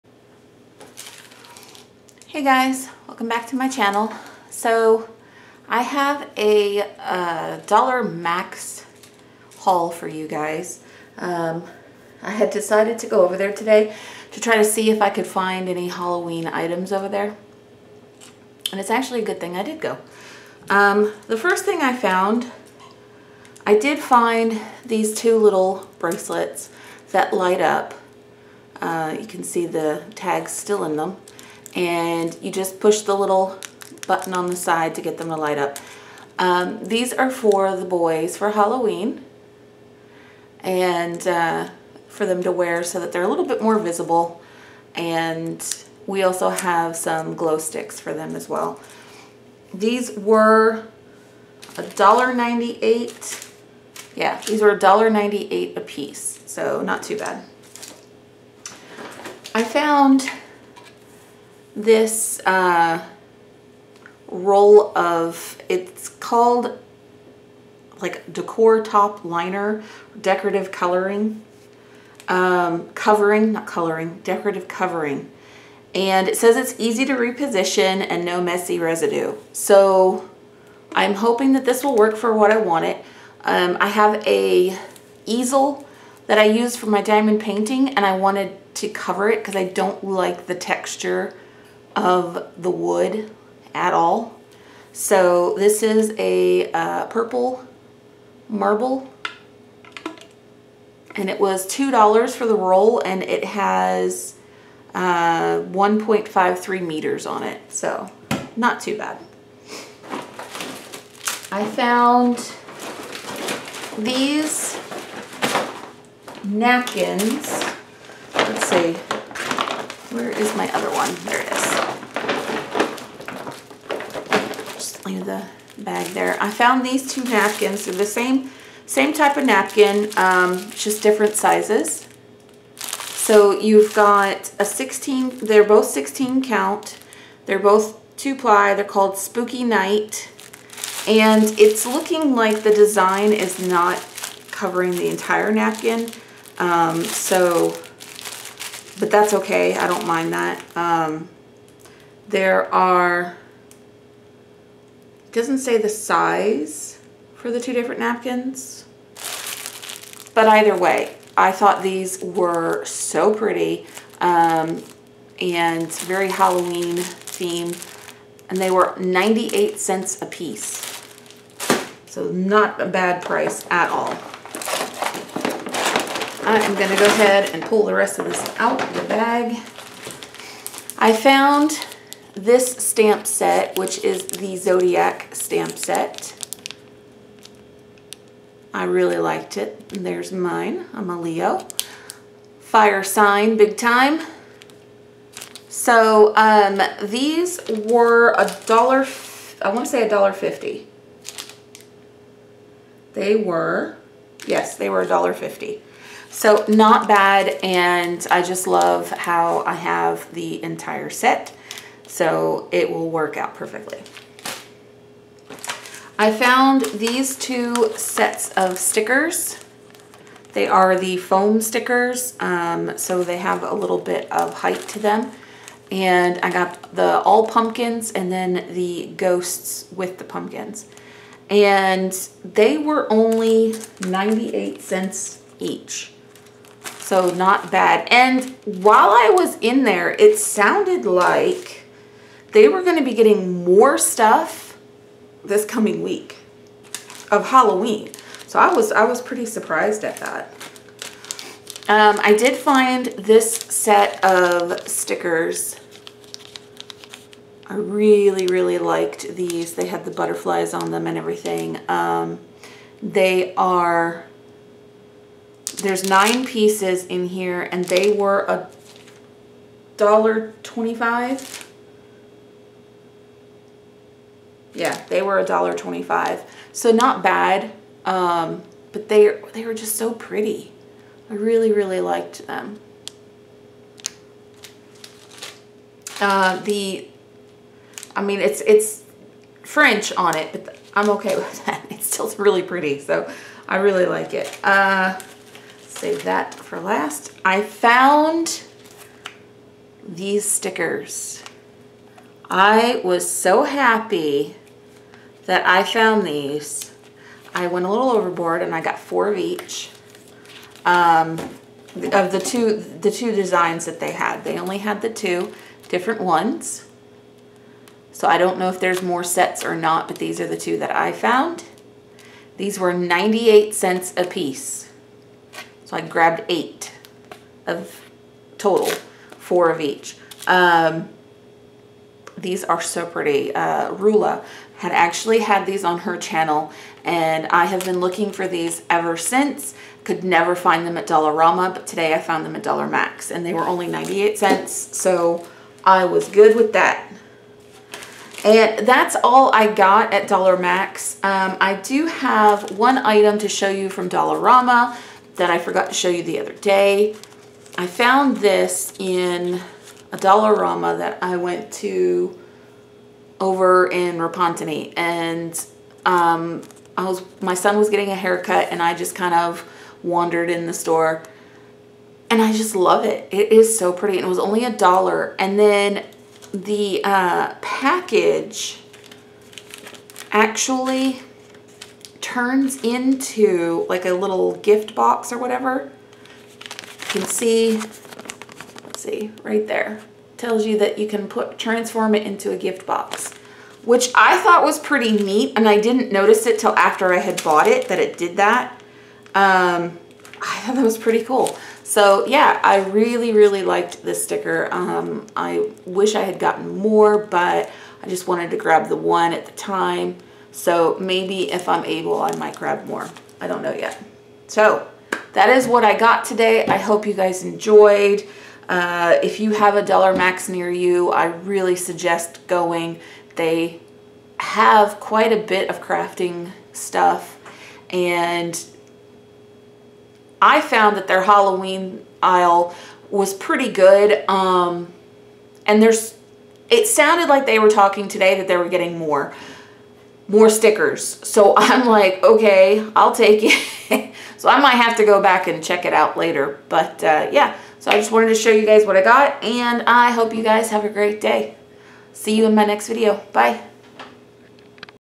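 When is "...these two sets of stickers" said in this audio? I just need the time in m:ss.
3:36.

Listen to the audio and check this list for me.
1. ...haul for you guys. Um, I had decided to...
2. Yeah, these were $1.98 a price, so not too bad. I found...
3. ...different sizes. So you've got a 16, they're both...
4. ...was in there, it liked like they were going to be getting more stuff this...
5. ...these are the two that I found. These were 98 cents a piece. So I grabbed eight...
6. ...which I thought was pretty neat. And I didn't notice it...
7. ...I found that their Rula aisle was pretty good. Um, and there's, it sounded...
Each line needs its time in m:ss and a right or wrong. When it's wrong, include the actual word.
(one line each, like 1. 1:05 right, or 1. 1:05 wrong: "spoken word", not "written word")
1. 0:09 right
2. 0:54 wrong: "piece", not "price"
3. 2:11 right
4. 3:59 wrong: "sounded", not "liked"
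5. 5:20 right
6. 6:33 right
7. 7:10 wrong: "Halloween", not "Rula".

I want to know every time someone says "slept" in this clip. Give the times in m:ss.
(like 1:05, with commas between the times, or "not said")
not said.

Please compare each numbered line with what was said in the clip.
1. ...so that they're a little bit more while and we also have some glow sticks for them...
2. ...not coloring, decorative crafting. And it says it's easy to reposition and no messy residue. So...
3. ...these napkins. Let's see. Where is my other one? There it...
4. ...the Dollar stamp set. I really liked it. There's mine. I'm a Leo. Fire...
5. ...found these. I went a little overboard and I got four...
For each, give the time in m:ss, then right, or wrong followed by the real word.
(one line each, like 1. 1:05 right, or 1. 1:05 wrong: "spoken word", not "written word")
1. 0:42 wrong: "visible", not "while"
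2. 1:13 wrong: "covering", not "crafting"
3. 1:53 right
4. 3:04 wrong: "Zodiac", not "Dollar"
5. 5:05 right.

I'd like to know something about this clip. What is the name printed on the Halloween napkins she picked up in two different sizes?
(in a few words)
Spooky Night.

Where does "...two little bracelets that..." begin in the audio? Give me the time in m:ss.
0:25.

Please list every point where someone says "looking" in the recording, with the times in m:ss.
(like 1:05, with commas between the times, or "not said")
2:21, 5:37.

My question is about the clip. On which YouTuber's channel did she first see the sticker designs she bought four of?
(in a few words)
Rula.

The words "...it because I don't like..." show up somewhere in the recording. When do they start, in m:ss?
1:29.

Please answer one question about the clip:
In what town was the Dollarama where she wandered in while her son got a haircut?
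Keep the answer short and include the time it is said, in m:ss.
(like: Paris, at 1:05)
Repentigny, at 6:04.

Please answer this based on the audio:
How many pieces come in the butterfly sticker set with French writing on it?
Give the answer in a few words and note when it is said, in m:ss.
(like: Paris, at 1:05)
9, at 4:26.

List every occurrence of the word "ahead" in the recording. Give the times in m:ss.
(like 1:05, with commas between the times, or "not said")
2:57.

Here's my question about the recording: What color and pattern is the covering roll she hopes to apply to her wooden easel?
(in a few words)
purple marble.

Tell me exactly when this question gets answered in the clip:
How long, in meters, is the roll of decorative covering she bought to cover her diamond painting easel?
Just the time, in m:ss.
1:45.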